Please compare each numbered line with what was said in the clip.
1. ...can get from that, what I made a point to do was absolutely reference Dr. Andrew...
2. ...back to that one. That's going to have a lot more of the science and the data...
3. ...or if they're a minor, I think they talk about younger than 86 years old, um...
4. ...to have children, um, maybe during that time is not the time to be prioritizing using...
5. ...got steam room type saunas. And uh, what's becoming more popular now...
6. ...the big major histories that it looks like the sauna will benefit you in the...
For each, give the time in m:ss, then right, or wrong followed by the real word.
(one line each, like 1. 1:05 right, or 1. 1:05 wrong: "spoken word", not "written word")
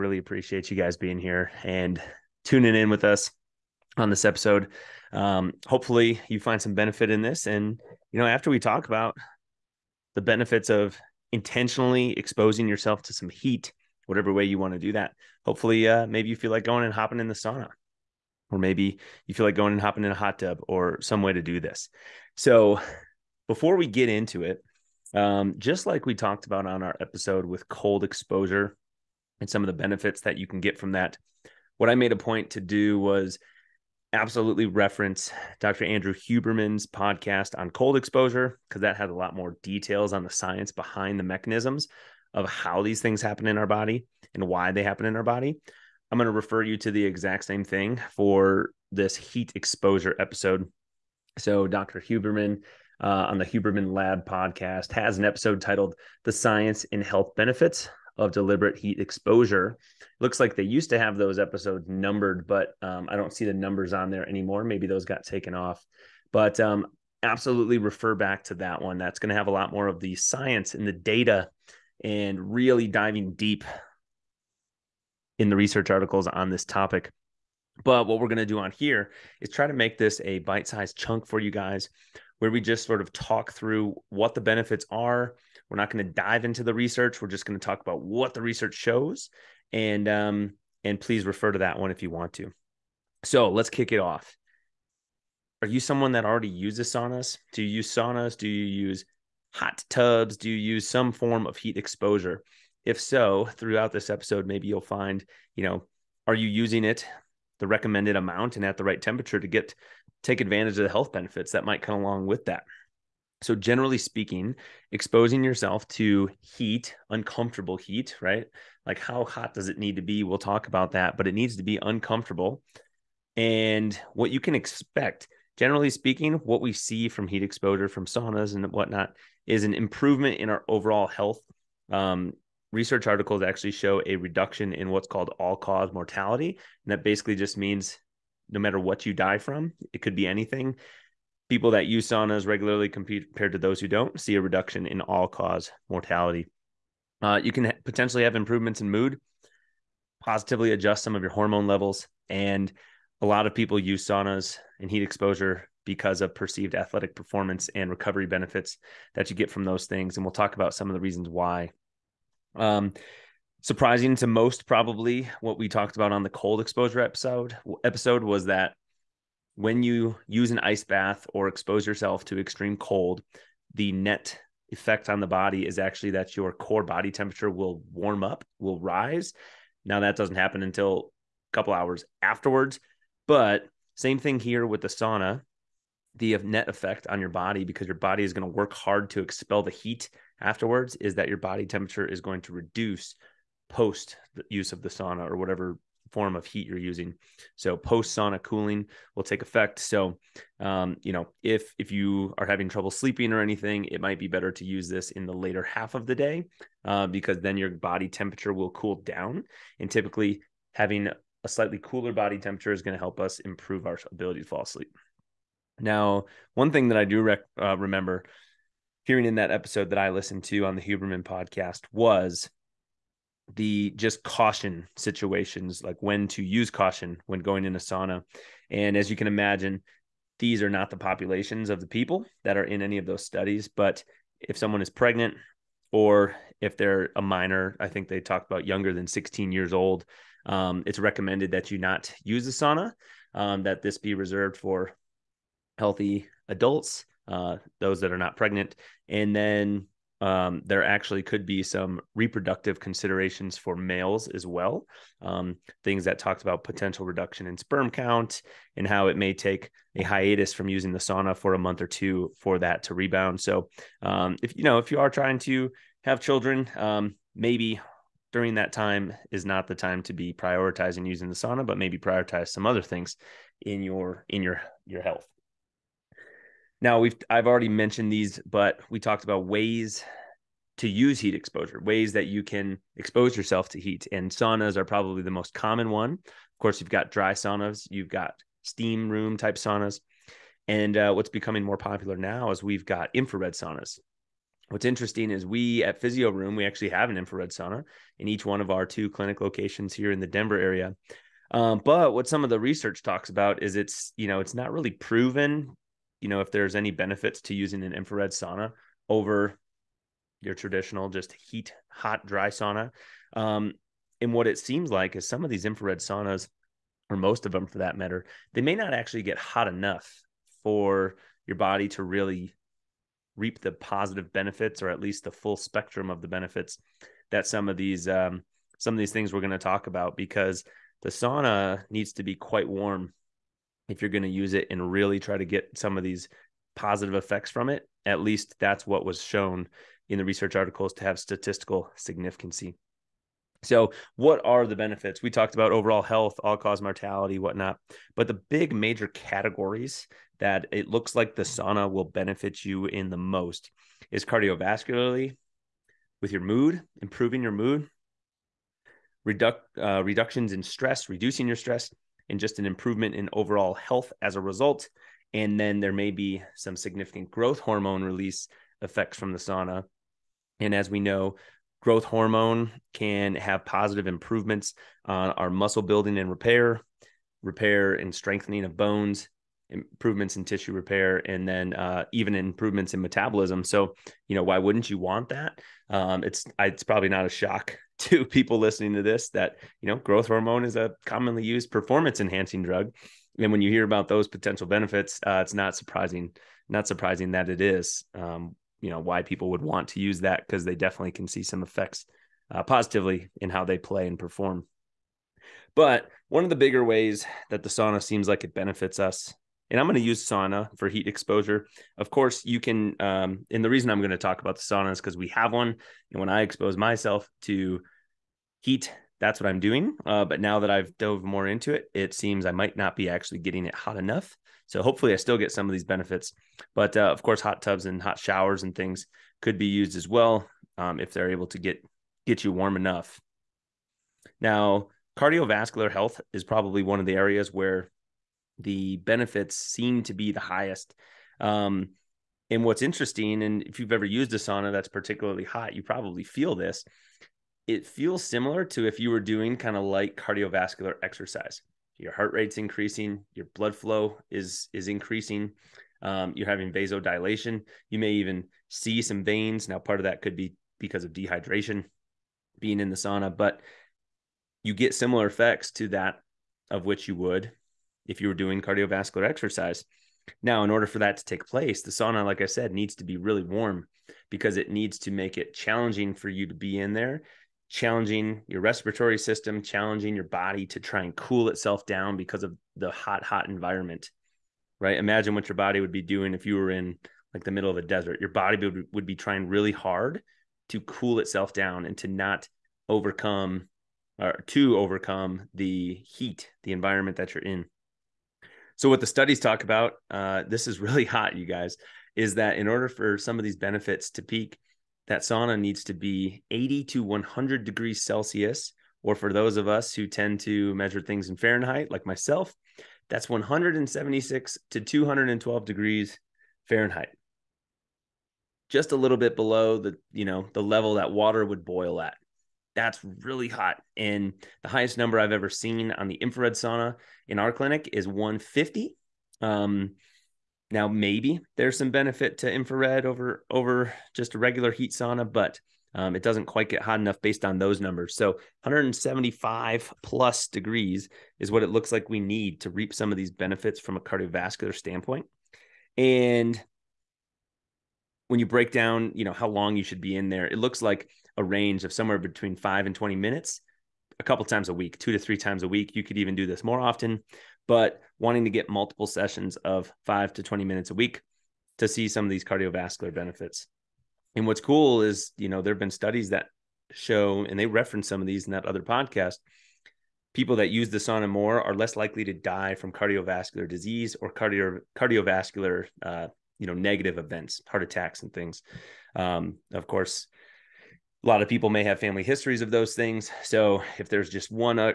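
1. 0:30 right
2. 1:08 right
3. 3:55 wrong: "16", not "86"
4. 4:25 right
5. 4:48 right
6. 5:48 wrong: "categories", not "histories".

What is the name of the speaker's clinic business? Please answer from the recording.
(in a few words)
Physio Room.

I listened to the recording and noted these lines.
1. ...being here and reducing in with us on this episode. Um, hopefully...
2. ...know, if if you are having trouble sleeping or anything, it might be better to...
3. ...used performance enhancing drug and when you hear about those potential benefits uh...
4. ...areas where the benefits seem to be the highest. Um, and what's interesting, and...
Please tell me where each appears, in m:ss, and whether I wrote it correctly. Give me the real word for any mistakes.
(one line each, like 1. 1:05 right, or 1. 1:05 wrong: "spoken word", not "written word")
1. 0:00 wrong: "tuning", not "reducing"
2. 3:21 right
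3. 6:31 right
4. 7:17 right.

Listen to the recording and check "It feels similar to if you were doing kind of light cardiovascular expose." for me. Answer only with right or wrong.
wrong.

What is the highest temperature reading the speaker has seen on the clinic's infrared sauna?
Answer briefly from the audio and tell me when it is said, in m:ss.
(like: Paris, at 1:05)
150, at 8:48.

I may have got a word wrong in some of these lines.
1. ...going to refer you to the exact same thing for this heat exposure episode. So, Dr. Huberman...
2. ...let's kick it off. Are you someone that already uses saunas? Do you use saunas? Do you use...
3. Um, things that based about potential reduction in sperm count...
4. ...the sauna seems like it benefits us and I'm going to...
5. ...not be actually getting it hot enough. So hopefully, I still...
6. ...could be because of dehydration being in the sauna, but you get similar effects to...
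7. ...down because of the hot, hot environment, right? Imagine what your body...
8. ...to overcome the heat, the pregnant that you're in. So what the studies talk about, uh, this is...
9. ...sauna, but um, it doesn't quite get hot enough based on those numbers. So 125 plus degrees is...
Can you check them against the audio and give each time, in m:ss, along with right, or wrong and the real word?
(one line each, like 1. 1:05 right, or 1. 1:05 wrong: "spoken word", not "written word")
1. 0:46 right
2. 1:33 right
3. 4:15 wrong: "talked", not "based"
4. 6:47 right
5. 7:02 right
6. 7:40 right
7. 8:01 right
8. 8:14 wrong: "environment", not "pregnant"
9. 8:54 wrong: "175", not "125".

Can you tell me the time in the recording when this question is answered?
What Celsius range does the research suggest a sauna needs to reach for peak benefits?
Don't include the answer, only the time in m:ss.
8:26.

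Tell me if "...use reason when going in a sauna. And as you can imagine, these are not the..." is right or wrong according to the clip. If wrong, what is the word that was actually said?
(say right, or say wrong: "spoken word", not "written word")
wrong: "caution", not "reason".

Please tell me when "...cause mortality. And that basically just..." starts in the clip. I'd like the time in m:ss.
2:15.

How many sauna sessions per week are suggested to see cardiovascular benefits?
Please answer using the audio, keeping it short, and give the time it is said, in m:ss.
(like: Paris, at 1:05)
2 to 3, at 9:14.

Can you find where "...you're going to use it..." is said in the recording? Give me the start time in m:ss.
5:34.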